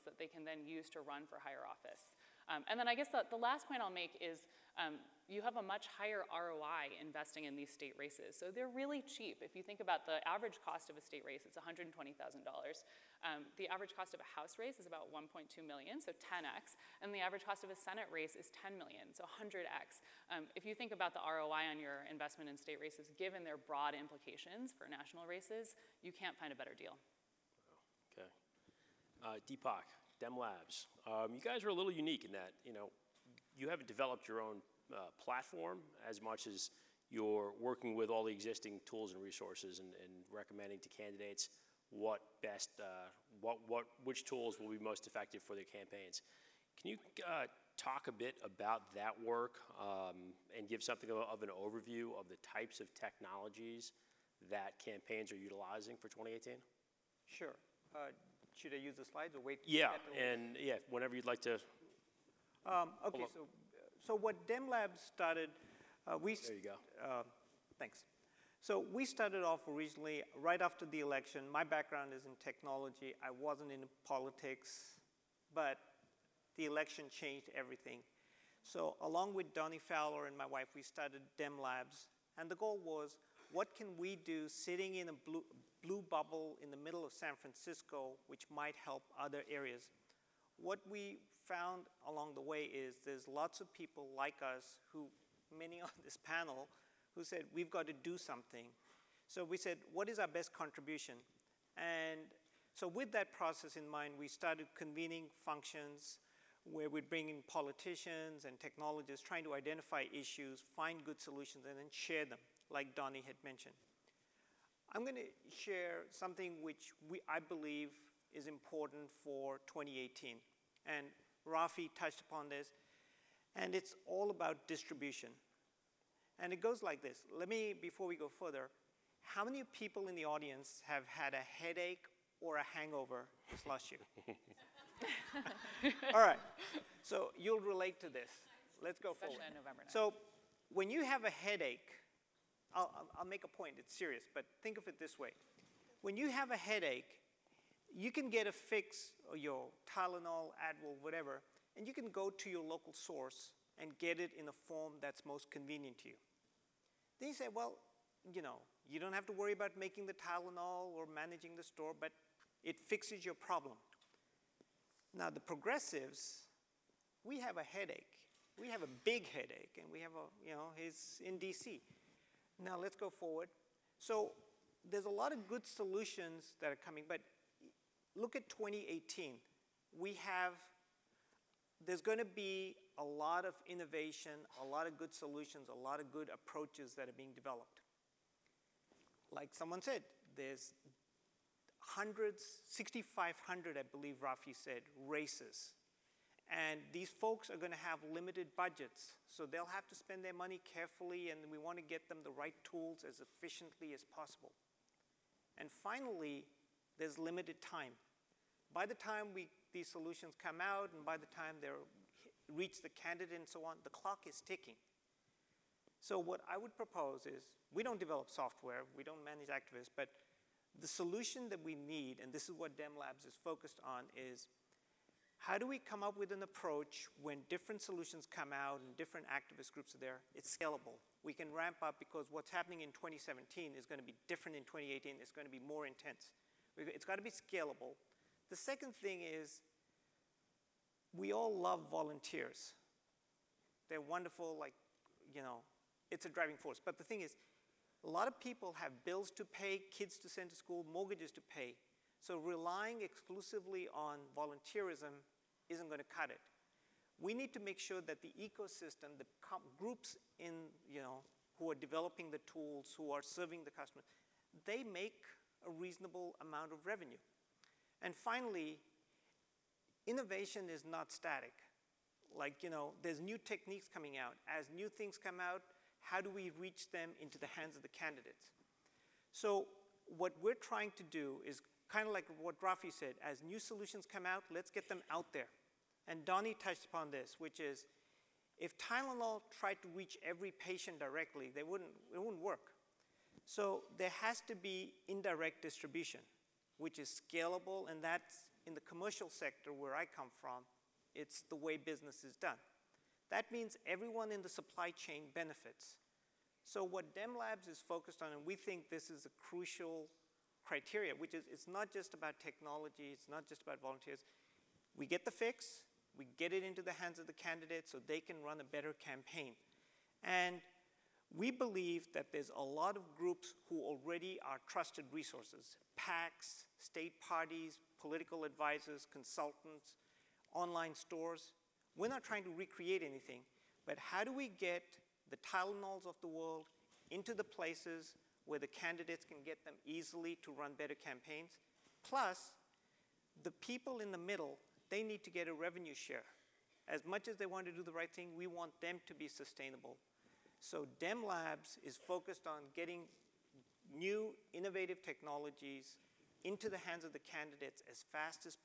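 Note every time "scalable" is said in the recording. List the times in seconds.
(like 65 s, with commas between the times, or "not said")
230 s, 237 s, 297 s.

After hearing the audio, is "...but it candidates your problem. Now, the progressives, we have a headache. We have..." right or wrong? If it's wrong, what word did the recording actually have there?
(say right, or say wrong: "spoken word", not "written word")
wrong: "fixes", not "candidates".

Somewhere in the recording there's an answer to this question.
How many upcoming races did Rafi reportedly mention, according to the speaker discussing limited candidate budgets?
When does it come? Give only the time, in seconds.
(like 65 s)
192 s.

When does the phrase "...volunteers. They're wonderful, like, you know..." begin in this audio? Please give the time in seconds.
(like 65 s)
241 s.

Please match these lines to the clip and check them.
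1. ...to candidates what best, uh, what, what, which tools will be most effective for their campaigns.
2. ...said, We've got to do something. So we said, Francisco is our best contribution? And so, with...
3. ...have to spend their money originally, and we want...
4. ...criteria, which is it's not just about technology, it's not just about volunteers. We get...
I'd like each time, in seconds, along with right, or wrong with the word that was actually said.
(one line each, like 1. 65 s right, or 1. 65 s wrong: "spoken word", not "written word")
1. 40 s right
2. 97 s wrong: "What", not "Francisco"
3. 199 s wrong: "carefully", not "originally"
4. 310 s right.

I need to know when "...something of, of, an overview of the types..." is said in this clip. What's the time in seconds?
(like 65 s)
50 s.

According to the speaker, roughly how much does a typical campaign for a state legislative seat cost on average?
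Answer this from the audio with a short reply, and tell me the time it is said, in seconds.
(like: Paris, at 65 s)
$120,000, at 11 s.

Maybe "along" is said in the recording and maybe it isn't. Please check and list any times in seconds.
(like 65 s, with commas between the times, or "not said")
79 s, 92 s.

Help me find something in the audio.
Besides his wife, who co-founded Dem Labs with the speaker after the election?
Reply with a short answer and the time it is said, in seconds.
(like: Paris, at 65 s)
Donnie Fowler, at 79 s.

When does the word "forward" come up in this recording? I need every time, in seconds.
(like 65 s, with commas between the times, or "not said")
139 s, 173 s.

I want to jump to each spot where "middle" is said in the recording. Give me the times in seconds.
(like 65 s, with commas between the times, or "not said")
86 s, 344 s.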